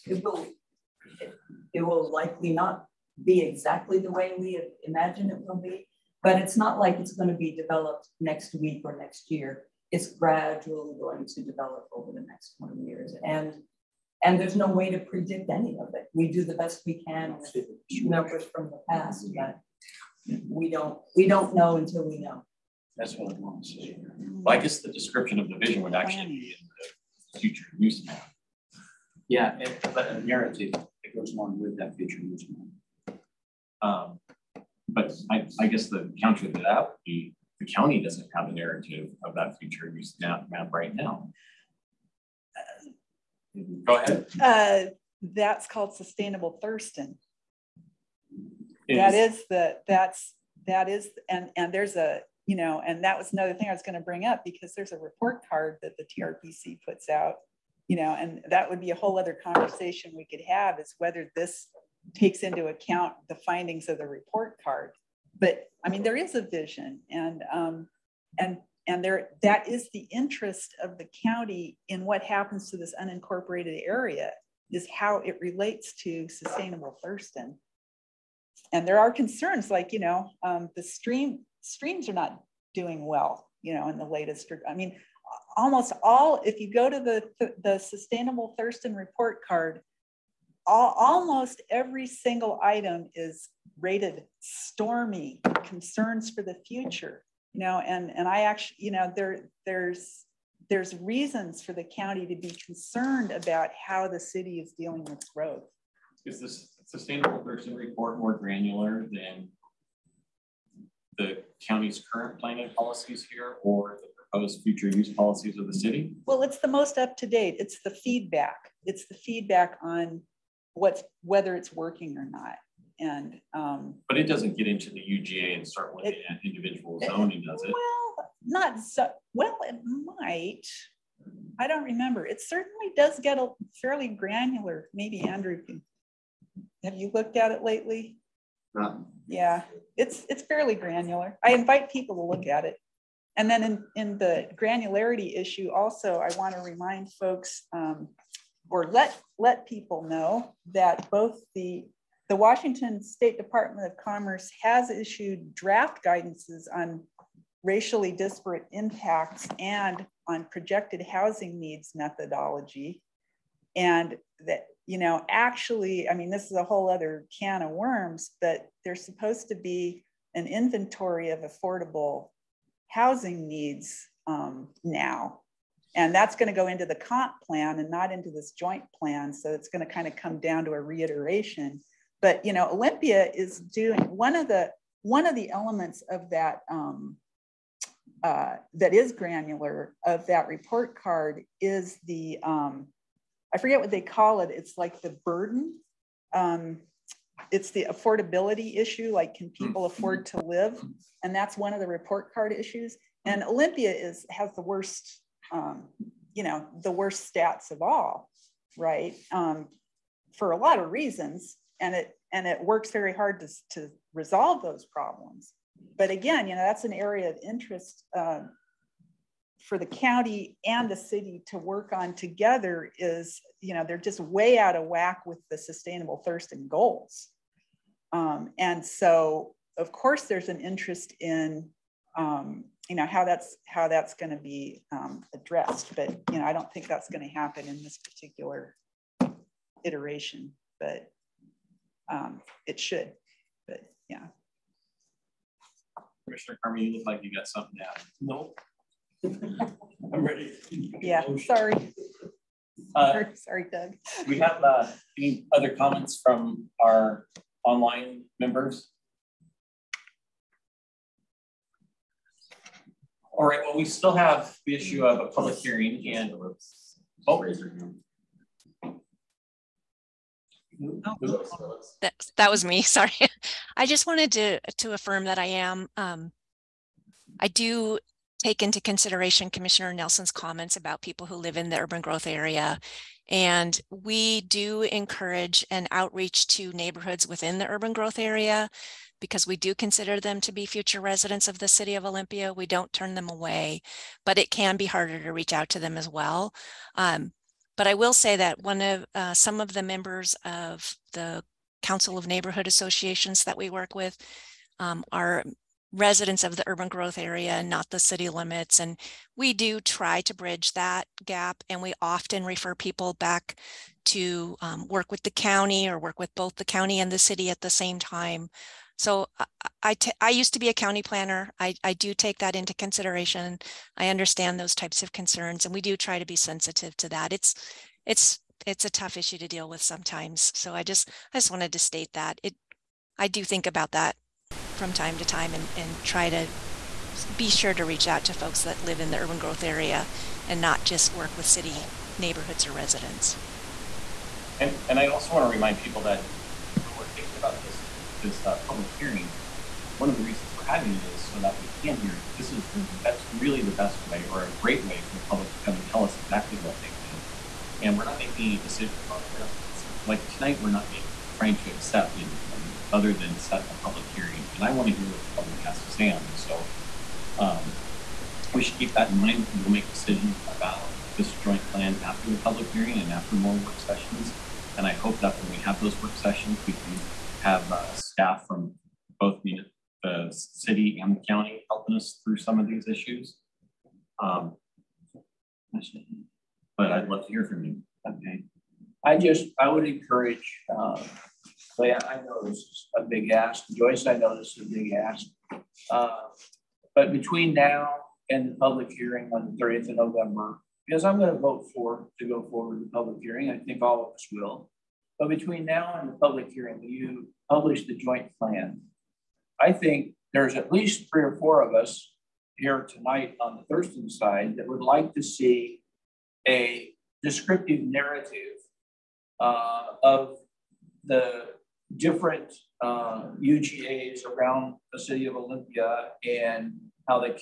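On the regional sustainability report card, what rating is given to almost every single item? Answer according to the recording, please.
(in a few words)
Stormy.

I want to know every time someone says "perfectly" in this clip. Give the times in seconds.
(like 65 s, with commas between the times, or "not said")
not said.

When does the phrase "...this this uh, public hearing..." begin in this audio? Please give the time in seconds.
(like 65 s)
347 s.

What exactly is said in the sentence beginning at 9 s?
It's gradually going to develop over the next 20 years.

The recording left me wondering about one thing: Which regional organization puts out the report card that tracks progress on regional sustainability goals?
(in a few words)
TRPC.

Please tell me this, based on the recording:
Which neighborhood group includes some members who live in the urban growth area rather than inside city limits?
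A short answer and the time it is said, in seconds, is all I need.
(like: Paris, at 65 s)
Council of Neighborhood Associations, at 301 s.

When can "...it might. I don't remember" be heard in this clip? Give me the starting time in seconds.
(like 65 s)
129 s.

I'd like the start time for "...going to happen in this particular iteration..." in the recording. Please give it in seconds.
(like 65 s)
237 s.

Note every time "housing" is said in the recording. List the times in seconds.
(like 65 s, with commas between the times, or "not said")
161 s, 172 s.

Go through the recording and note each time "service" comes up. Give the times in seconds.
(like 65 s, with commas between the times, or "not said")
not said.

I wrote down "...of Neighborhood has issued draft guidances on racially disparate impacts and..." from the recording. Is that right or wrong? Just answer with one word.
wrong.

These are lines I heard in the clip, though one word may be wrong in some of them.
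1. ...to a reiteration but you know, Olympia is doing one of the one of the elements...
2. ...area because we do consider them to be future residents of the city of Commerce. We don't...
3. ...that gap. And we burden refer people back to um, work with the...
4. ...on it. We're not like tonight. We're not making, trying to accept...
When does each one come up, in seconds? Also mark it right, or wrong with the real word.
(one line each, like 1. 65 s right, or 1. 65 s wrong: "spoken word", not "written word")
1. 180 s right
2. 288 s wrong: "Olympia", not "Commerce"
3. 310 s wrong: "often", not "burden"
4. 359 s right.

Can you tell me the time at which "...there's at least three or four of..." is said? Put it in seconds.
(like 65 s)
410 s.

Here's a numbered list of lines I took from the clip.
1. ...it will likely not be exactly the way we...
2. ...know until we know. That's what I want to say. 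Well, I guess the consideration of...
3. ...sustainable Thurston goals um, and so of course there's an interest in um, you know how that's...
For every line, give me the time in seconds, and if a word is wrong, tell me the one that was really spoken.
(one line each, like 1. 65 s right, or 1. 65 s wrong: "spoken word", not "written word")
1. 1 s right
2. 21 s wrong: "description", not "consideration"
3. 225 s right.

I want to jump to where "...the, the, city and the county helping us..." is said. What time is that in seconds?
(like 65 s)
379 s.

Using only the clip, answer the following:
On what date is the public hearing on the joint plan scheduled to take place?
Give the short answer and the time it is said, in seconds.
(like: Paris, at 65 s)
November 30, at 399 s.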